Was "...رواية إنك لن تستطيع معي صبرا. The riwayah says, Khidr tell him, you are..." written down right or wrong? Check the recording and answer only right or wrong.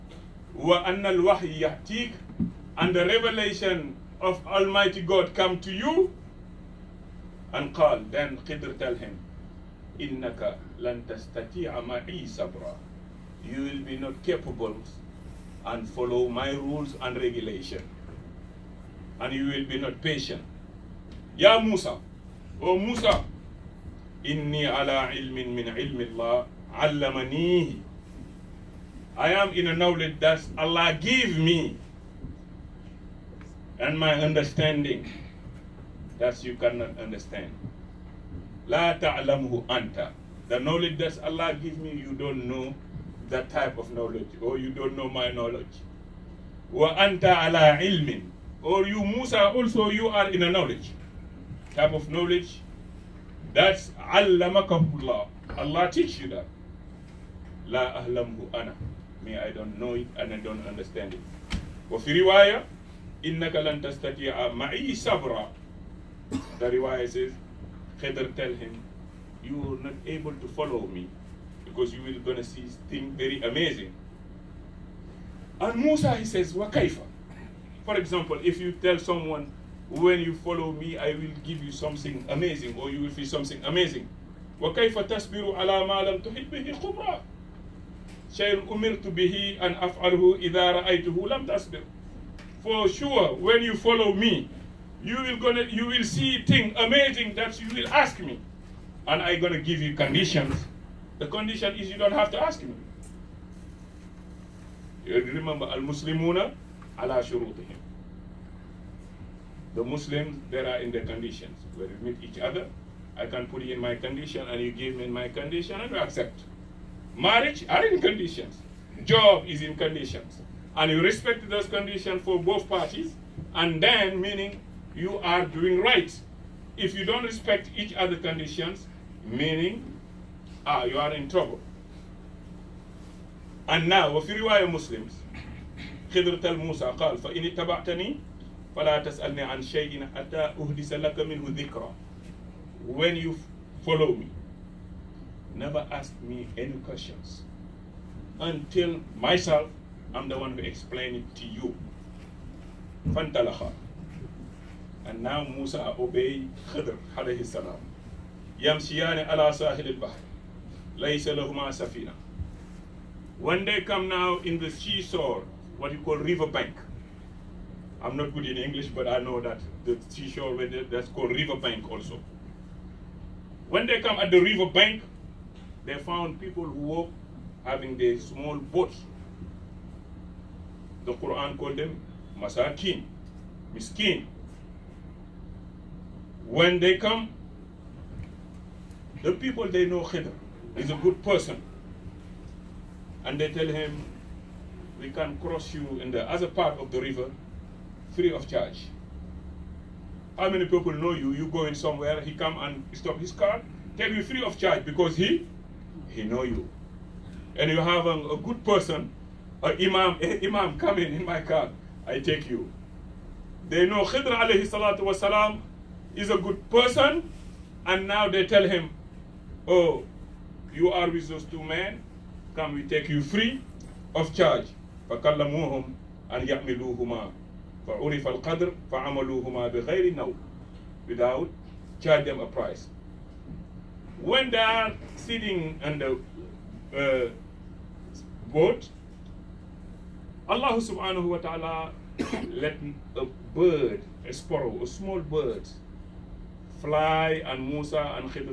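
right.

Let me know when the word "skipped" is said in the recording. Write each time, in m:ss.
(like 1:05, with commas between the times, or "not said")
not said.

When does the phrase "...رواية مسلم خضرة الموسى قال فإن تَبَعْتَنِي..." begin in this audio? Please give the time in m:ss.
2:14.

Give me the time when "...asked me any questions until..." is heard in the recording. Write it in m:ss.
2:25.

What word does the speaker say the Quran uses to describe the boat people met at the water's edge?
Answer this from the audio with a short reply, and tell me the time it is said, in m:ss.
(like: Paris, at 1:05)
masakin, at 3:02.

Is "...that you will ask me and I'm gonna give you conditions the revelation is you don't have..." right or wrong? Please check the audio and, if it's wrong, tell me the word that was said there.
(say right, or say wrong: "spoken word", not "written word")
wrong: "condition", not "revelation".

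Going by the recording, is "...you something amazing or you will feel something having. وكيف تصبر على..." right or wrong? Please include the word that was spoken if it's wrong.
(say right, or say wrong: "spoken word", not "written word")
wrong: "amazing", not "having".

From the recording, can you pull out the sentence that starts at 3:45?
فَكَلَّمُوهُمْ أَنْ يَعْمِلُوهُمَا فعرف القدر فعملوهما بغير now, without charge them a price.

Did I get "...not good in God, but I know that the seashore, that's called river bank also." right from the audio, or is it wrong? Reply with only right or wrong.
wrong.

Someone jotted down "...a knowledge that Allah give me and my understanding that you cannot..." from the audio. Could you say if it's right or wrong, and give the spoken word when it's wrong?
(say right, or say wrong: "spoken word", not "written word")
right.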